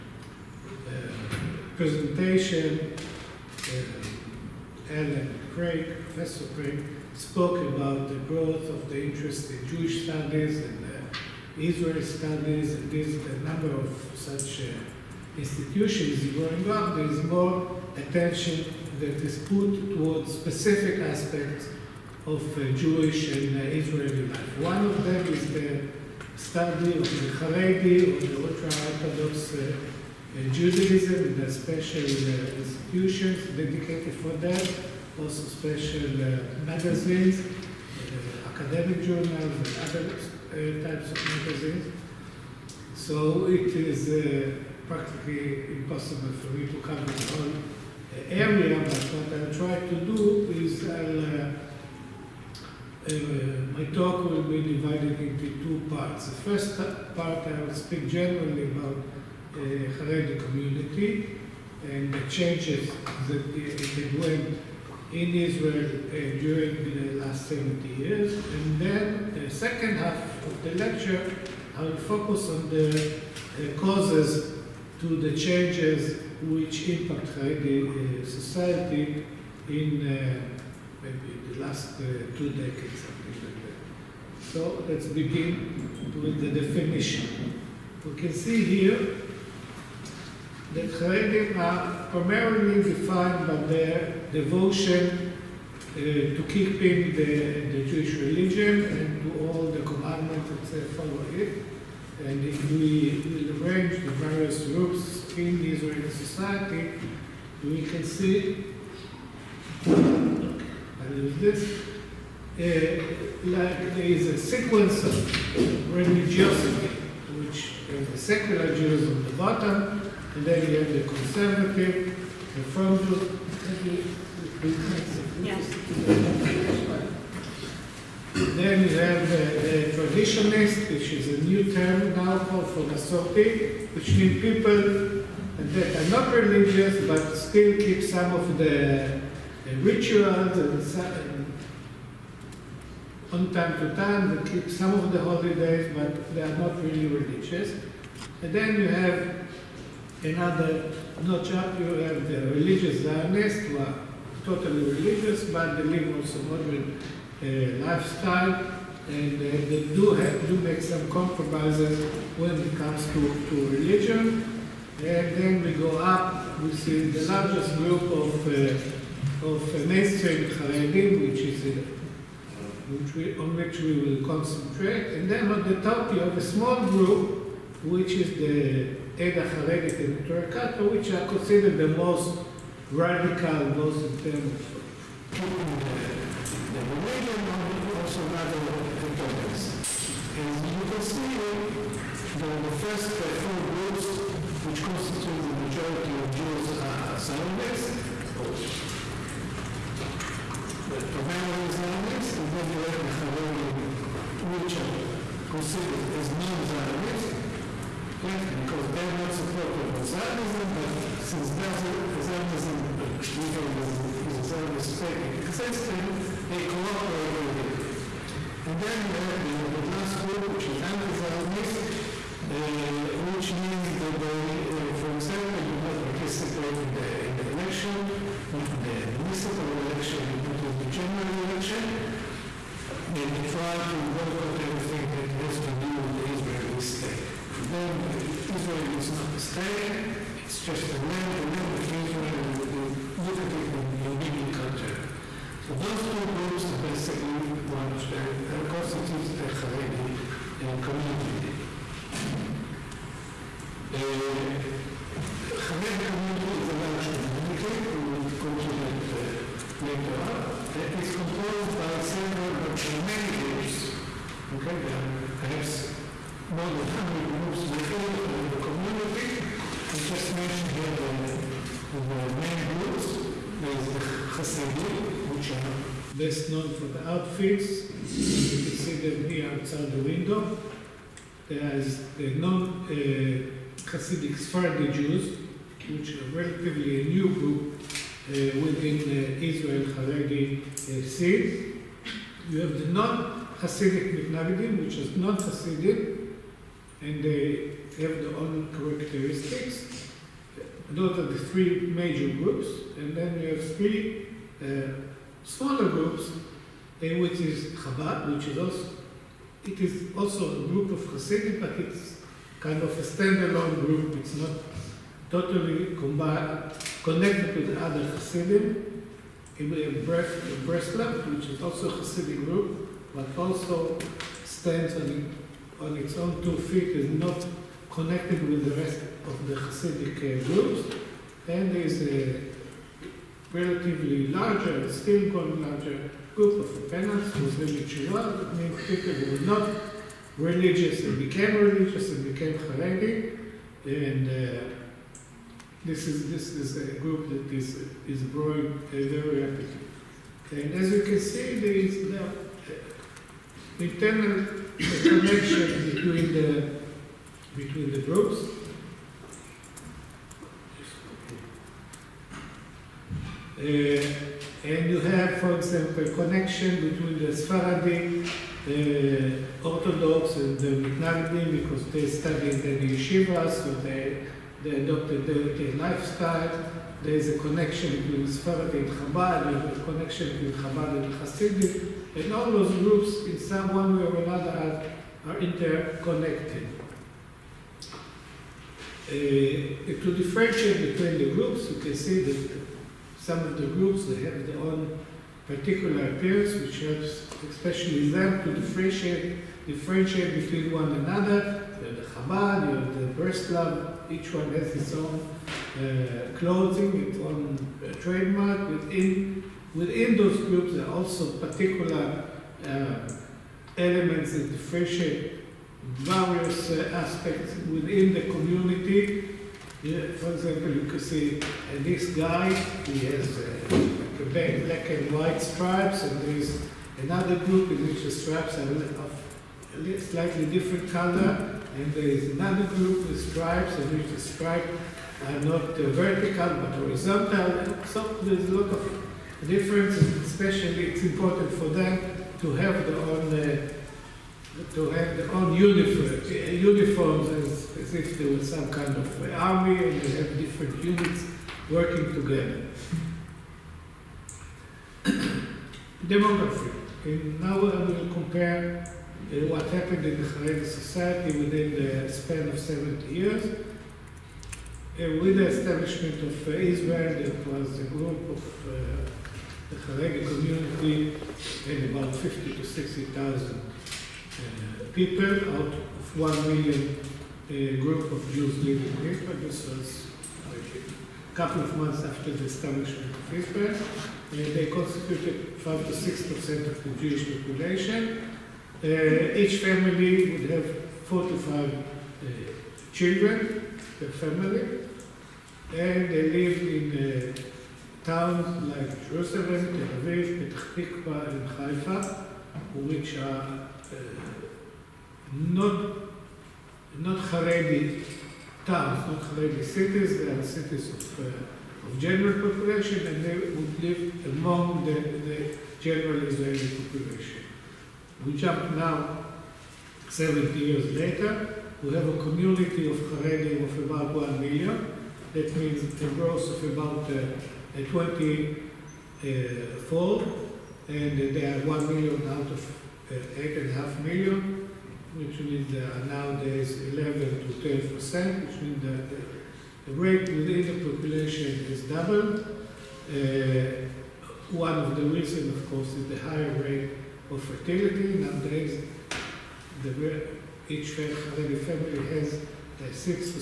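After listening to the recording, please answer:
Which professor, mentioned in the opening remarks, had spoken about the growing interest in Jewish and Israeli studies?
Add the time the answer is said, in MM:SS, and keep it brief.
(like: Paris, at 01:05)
Alan Craig, at 00:04.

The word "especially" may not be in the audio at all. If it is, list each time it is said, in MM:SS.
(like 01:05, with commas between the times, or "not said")
06:37, 07:20.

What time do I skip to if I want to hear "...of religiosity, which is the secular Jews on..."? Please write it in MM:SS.
01:55.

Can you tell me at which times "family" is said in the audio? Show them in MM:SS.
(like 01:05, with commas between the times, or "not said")
08:09, 08:14, 09:11.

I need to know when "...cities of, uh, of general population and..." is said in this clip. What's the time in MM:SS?
08:30.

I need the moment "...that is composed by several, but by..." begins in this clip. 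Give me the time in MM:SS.
04:20.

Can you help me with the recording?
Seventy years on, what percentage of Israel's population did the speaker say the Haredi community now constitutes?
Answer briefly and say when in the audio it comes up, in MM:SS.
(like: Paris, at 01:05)
11 to 12 percent, at 08:56.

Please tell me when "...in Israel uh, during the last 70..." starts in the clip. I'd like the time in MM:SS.
01:05.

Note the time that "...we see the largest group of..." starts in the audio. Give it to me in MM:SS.
02:46.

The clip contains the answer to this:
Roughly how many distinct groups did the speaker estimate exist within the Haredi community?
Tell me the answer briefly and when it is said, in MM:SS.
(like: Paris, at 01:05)
more than 100, at 04:26.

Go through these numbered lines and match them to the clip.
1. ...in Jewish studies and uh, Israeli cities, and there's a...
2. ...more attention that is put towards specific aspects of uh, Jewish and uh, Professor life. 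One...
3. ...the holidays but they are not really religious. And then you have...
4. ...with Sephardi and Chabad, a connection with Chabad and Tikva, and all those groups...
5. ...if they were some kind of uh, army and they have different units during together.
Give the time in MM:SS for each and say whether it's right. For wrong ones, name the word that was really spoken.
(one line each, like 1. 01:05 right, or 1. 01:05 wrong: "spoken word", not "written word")
1. 00:09 wrong: "studies", not "cities"
2. 00:17 wrong: "Israeli", not "Professor"
3. 02:25 right
4. 06:18 wrong: "Hasidic", not "Tikva"
5. 07:27 wrong: "working", not "during".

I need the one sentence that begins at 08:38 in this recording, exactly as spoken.
We jump now 70 years later, we have a community of Haredim of about 1 million.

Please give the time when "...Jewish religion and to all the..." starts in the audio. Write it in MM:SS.
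01:37.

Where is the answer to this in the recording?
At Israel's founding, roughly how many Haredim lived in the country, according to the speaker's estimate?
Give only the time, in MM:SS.
07:52.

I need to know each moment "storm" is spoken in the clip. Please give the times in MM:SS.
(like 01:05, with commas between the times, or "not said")
not said.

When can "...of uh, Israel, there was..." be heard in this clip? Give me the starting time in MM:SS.
07:46.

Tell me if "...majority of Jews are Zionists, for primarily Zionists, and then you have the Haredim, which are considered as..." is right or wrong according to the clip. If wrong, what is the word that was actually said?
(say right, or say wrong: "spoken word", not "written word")
right.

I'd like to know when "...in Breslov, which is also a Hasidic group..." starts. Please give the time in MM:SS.
05:19.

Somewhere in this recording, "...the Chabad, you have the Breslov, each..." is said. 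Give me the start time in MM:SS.
06:41.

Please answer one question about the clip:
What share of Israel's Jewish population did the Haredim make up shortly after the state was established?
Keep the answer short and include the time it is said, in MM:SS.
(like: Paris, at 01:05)
5 to 6 percent, at 08:05.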